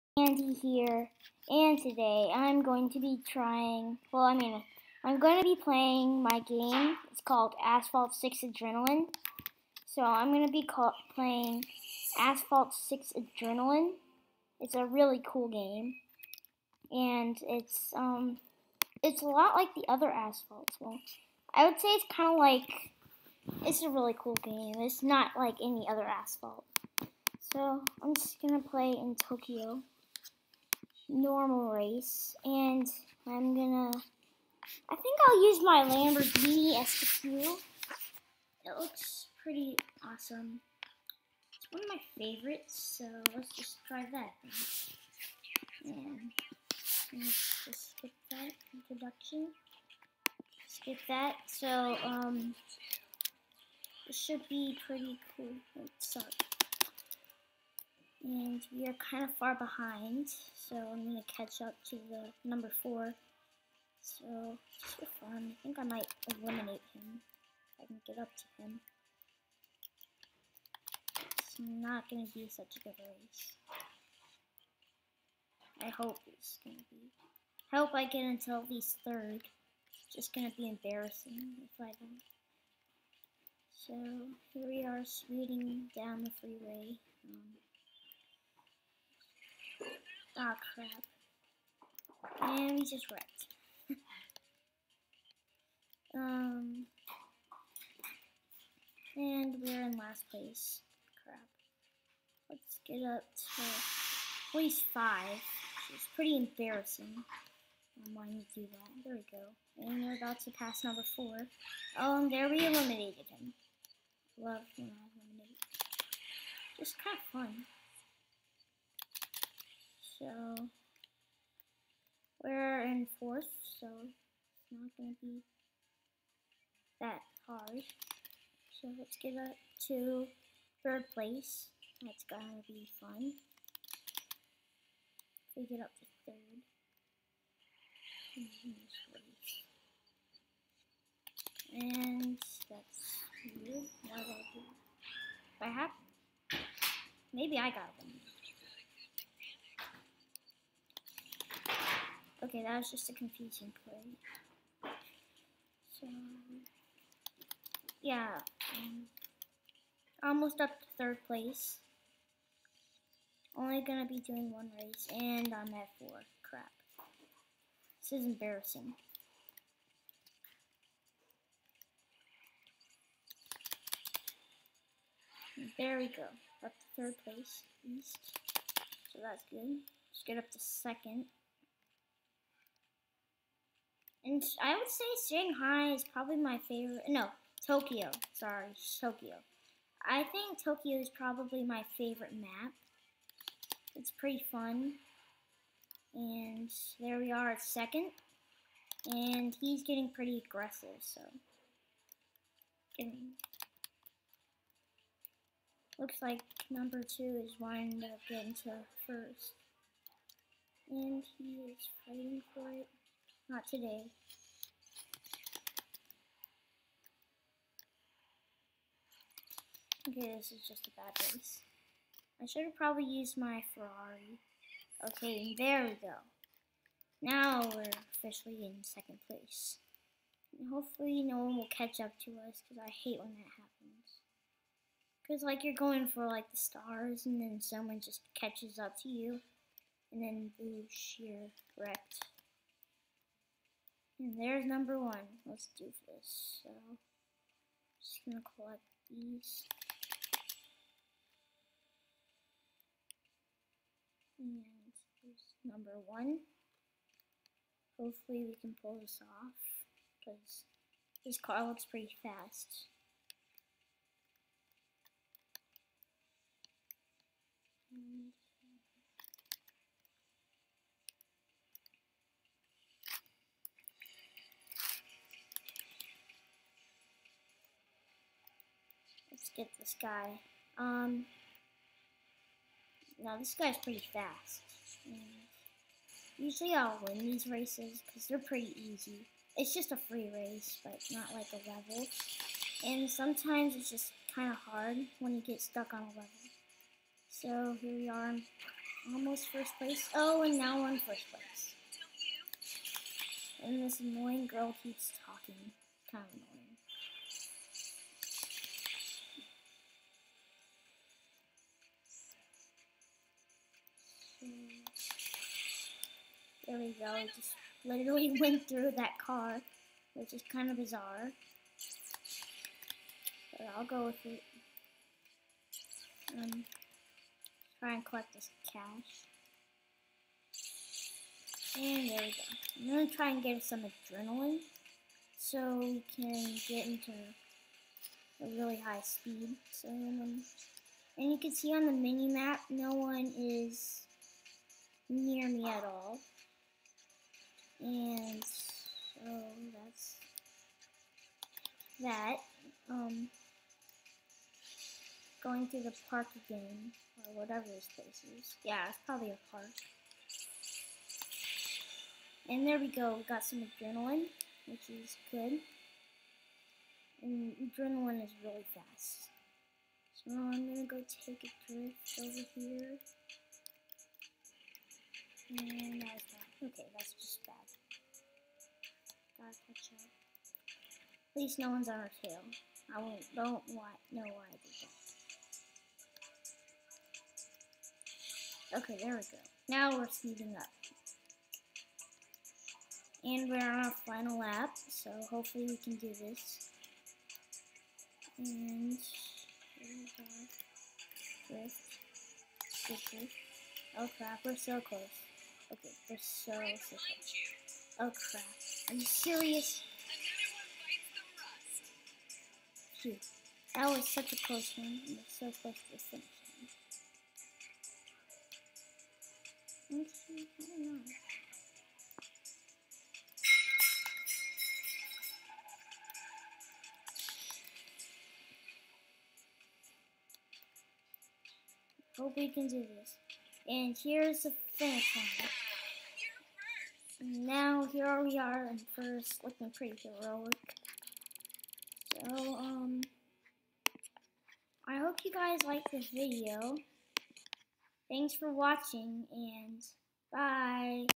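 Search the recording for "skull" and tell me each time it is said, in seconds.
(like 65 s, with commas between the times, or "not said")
not said.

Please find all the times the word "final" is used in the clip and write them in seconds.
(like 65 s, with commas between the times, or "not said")
394 s.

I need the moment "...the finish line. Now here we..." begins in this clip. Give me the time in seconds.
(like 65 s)
434 s.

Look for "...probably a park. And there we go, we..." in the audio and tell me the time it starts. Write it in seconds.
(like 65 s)
359 s.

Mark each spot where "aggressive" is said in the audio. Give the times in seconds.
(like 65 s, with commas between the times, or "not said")
200 s.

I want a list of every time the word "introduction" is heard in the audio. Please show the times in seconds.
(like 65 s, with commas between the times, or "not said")
48 s.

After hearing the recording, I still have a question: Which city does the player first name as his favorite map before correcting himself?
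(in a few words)
Shanghai.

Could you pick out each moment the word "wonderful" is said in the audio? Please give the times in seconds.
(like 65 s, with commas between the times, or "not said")
not said.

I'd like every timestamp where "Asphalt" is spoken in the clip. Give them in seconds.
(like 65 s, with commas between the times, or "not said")
7 s, 12 s, 20 s, 26 s.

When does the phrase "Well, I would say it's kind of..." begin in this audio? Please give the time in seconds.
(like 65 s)
20 s.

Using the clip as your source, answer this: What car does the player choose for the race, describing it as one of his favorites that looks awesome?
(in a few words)
Lamborghini SQ.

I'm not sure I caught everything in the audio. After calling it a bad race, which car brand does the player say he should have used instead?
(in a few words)
Ferrari.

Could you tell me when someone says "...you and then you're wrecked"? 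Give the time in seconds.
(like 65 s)
239 s.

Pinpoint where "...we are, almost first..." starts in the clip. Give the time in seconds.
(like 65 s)
297 s.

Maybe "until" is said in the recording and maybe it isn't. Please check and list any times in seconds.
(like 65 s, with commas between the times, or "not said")
78 s.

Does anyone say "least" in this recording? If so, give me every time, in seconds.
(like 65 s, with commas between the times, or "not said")
78 s, 381 s.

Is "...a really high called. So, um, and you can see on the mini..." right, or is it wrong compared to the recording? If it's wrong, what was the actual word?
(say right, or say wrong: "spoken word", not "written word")
wrong: "speed", not "called".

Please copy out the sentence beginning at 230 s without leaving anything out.
And hopefully no one will catch up to us because I hate when that happens.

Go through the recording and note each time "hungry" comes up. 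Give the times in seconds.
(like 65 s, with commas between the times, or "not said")
not said.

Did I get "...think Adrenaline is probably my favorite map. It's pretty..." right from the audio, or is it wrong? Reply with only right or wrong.
wrong.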